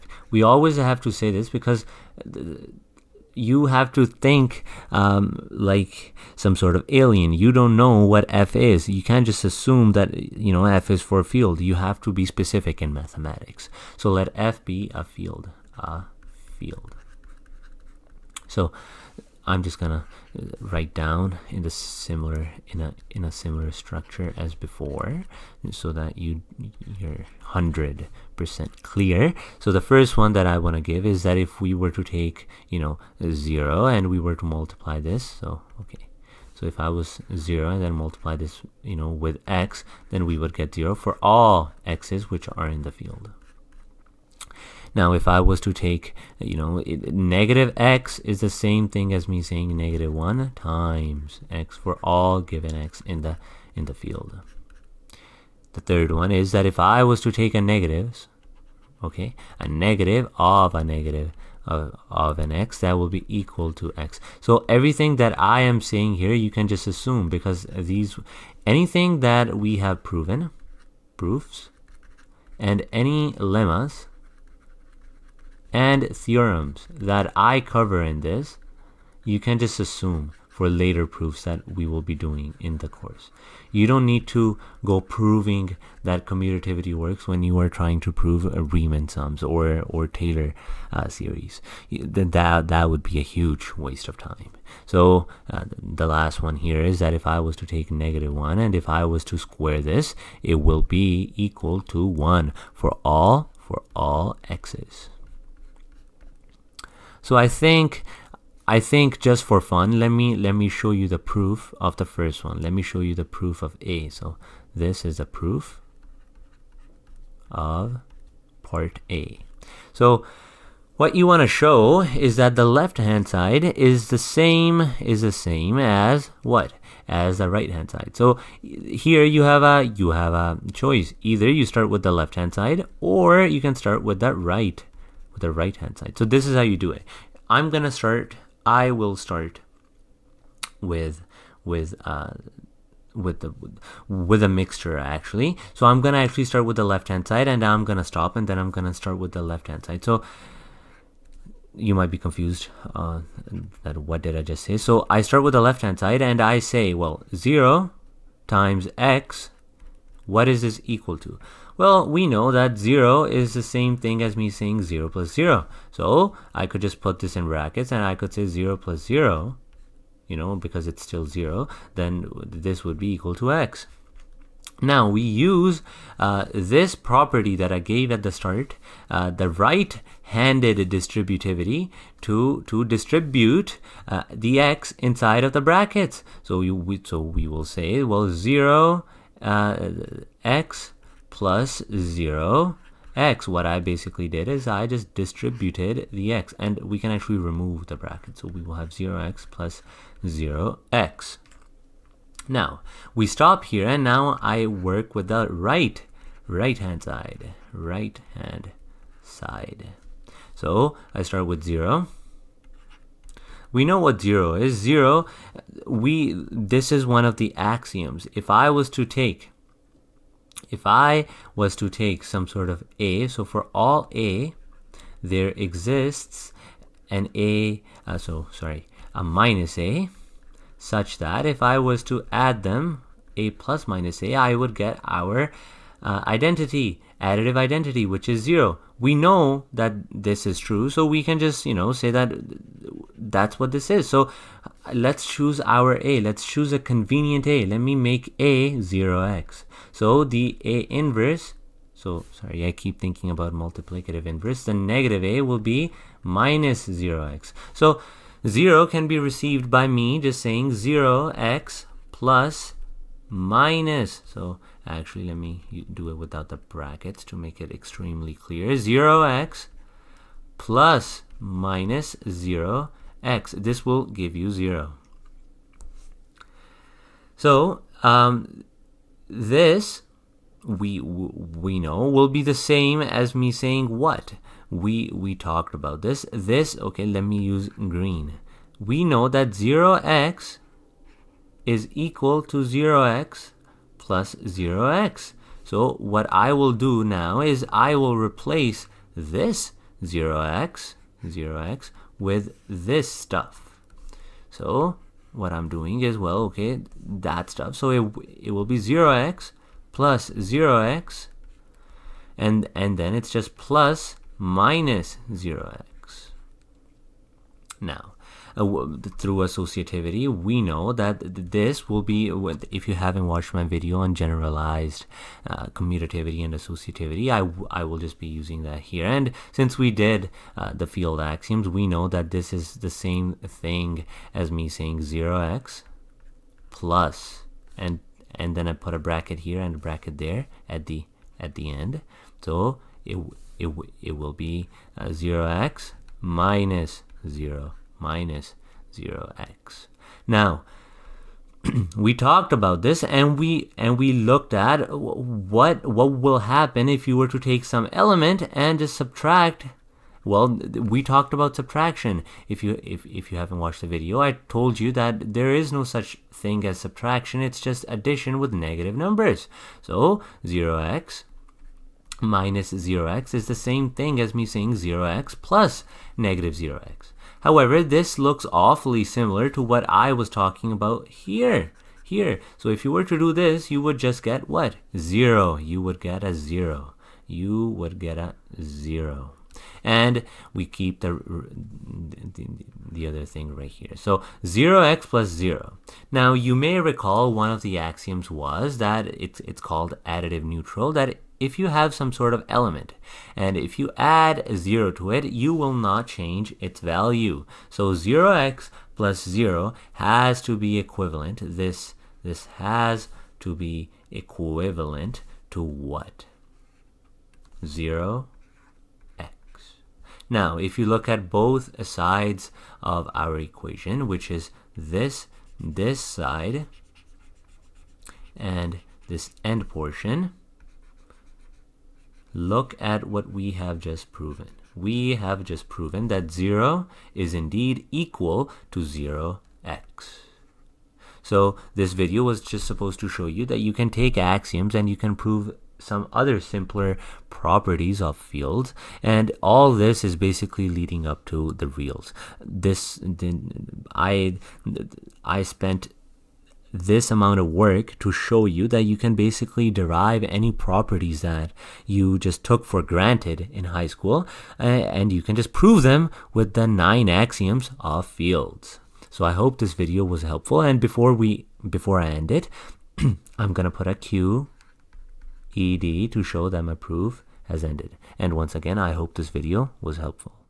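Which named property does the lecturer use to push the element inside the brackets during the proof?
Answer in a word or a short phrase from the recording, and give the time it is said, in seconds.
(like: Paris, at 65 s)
right-handed distributivity, at 179 s.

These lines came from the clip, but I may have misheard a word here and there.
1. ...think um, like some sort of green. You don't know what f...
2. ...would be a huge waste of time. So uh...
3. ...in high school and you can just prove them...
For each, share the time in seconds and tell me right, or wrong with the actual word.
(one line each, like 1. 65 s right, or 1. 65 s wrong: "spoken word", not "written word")
1. 4 s wrong: "alien", not "green"
2. 92 s right
3. 463 s right.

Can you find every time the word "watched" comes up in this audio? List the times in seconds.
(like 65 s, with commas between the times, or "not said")
323 s, 363 s.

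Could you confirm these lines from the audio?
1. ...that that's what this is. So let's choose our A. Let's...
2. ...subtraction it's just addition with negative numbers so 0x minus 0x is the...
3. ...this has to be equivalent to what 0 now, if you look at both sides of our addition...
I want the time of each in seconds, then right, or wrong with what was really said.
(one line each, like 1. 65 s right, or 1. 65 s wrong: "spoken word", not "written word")
1. 242 s right
2. 366 s right
3. 412 s wrong: "equation", not "addition".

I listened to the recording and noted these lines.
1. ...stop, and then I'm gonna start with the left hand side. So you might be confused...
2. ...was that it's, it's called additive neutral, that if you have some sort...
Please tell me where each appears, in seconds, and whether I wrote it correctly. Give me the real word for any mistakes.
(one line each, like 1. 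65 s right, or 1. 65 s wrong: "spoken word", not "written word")
1. 148 s right
2. 398 s right.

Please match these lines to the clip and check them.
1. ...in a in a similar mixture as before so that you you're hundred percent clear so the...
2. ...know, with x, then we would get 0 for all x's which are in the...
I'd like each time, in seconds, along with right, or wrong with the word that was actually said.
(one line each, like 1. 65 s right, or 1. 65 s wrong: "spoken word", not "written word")
1. 22 s wrong: "structure", not "mixture"
2. 38 s right.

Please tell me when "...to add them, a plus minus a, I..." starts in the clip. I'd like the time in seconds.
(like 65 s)
232 s.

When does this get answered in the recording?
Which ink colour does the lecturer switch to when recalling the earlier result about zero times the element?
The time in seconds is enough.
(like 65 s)
287 s.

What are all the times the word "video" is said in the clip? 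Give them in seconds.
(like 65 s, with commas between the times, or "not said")
323 s, 363 s, 441 s, 469 s, 479 s.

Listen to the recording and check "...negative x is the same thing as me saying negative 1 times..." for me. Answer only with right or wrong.
right.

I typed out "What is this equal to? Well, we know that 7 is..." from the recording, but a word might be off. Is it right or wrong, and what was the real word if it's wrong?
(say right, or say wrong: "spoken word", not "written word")
wrong: "0", not "7".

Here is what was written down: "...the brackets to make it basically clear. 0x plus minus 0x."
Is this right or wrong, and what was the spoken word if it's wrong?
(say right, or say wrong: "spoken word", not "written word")
wrong: "extremely", not "basically".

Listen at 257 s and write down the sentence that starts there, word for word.
So 0 can be received by me just saying 0x plus minus.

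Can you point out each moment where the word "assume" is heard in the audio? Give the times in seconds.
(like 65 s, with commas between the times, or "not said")
9 s, 66 s, 79 s.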